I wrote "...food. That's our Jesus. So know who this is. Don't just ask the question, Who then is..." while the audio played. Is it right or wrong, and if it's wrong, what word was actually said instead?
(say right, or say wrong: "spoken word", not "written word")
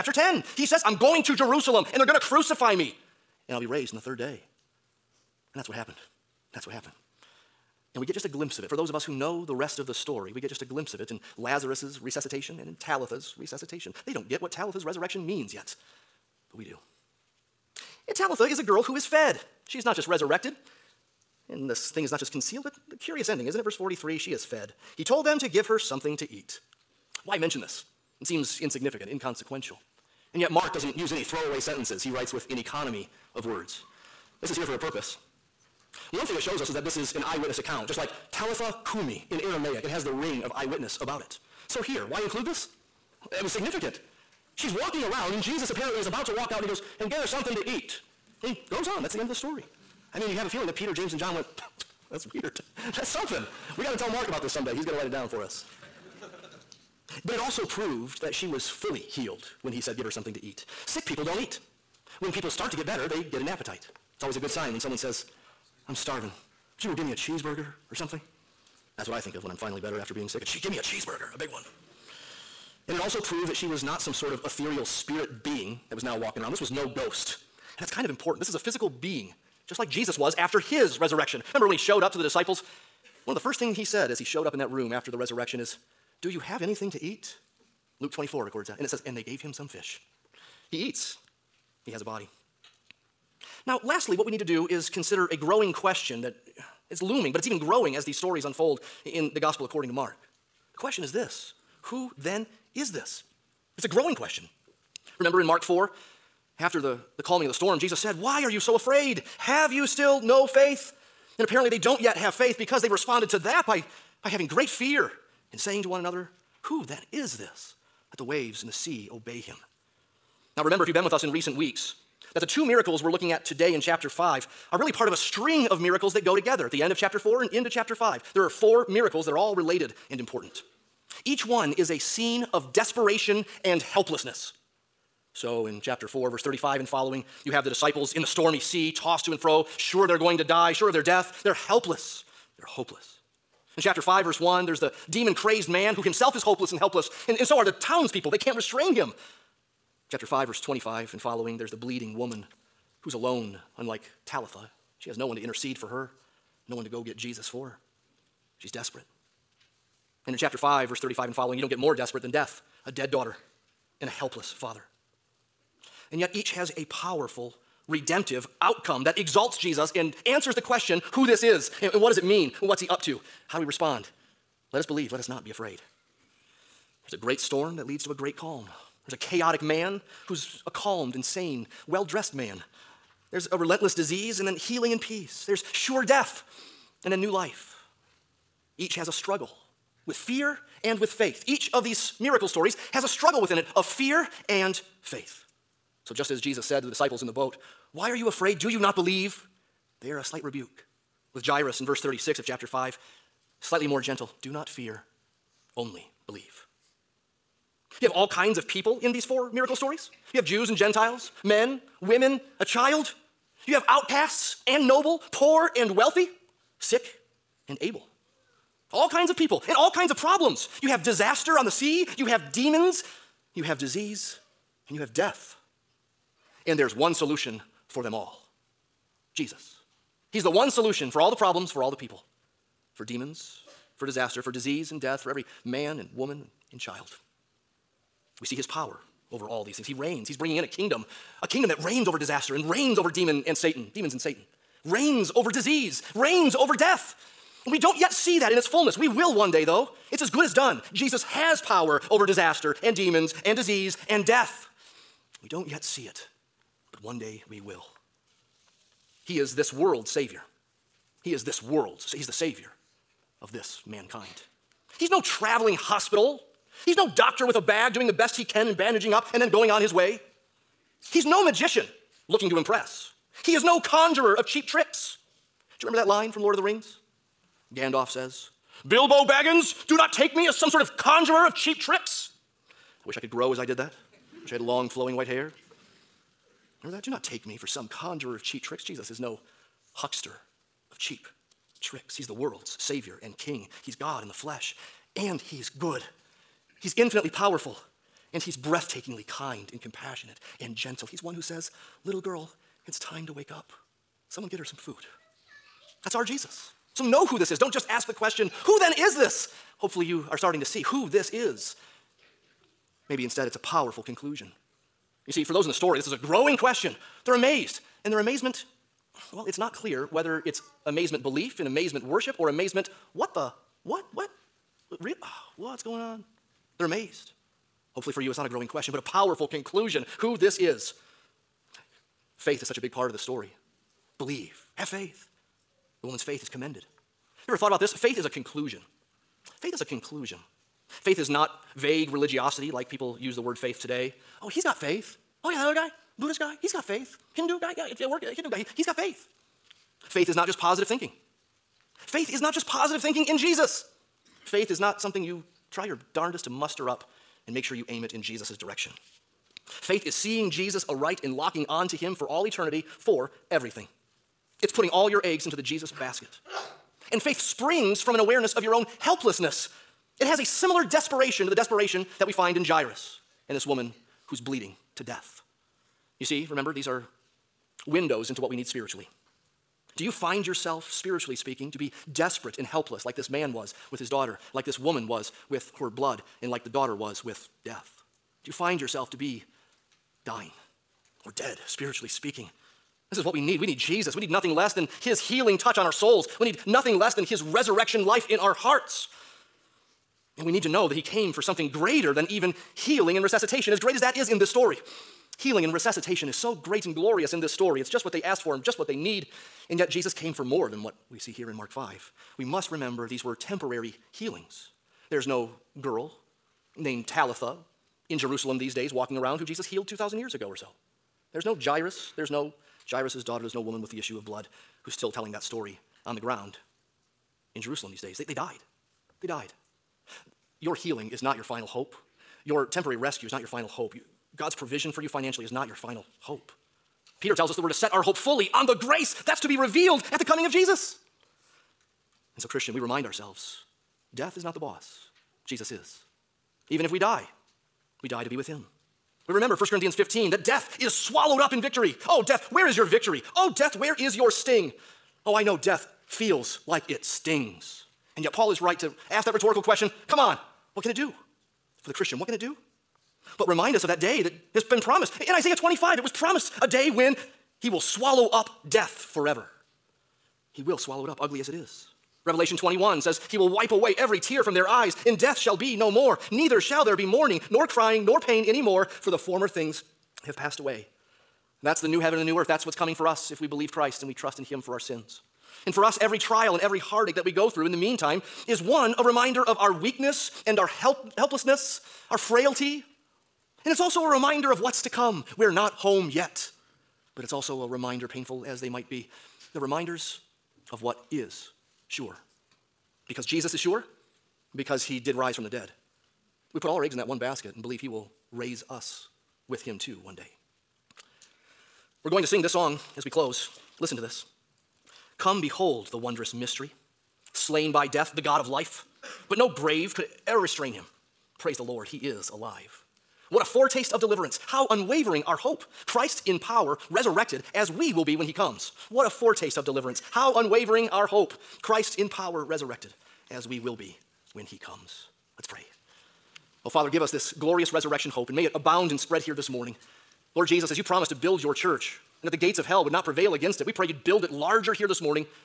right.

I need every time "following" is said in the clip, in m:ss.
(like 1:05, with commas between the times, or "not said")
2:16, 2:31, 2:41.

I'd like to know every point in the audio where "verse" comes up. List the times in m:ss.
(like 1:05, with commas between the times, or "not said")
0:23, 2:16, 2:24, 2:30, 2:40, 3:21.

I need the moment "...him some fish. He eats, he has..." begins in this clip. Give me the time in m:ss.
1:29.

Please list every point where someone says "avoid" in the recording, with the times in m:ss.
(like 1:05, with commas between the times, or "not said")
not said.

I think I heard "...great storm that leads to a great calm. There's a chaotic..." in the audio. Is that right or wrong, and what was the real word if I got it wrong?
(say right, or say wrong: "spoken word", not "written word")
right.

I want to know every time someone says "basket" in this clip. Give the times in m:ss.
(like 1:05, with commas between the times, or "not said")
6:05, 8:27.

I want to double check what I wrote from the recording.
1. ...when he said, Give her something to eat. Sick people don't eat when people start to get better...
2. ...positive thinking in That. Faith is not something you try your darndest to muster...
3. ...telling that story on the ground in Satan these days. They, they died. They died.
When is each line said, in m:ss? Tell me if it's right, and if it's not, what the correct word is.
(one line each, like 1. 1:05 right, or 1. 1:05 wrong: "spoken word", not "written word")
1. 0:59 right
2. 5:52 wrong: "Jesus", not "That"
3. 7:05 wrong: "Jerusalem", not "Satan".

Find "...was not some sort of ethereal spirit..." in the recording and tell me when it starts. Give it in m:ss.
1:13.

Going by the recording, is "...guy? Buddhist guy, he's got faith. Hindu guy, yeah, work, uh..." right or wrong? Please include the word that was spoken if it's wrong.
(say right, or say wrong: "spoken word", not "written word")
right.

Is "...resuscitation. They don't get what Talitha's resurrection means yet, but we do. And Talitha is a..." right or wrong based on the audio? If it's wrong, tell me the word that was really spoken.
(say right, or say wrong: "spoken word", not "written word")
right.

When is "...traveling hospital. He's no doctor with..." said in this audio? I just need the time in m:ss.
4:25.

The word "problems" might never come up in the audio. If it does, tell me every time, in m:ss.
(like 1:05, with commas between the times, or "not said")
3:40, 3:51.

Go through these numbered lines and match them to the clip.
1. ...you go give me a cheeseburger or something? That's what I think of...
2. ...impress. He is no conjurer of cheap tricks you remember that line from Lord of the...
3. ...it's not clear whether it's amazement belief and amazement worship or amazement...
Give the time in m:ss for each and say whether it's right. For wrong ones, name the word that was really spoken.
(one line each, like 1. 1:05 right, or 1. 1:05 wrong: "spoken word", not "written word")
1. 1:06 right
2. 4:32 right
3. 5:19 right.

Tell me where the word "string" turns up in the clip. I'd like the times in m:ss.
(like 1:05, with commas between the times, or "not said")
2:05.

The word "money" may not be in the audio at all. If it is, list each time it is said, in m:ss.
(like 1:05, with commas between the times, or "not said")
not said.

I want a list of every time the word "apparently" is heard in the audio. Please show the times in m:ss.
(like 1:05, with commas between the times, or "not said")
0:45, 1:51.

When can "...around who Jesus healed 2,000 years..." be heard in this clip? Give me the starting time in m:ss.
6:59.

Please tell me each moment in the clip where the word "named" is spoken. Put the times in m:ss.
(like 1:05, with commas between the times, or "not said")
6:56.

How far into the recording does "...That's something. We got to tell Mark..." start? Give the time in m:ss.
0:52.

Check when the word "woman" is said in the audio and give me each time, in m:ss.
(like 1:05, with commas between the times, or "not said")
2:32, 3:56, 5:36, 6:13, 6:24, 7:03.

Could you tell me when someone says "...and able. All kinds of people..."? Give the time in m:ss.
3:37.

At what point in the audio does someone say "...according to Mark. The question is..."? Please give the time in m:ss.
1:39.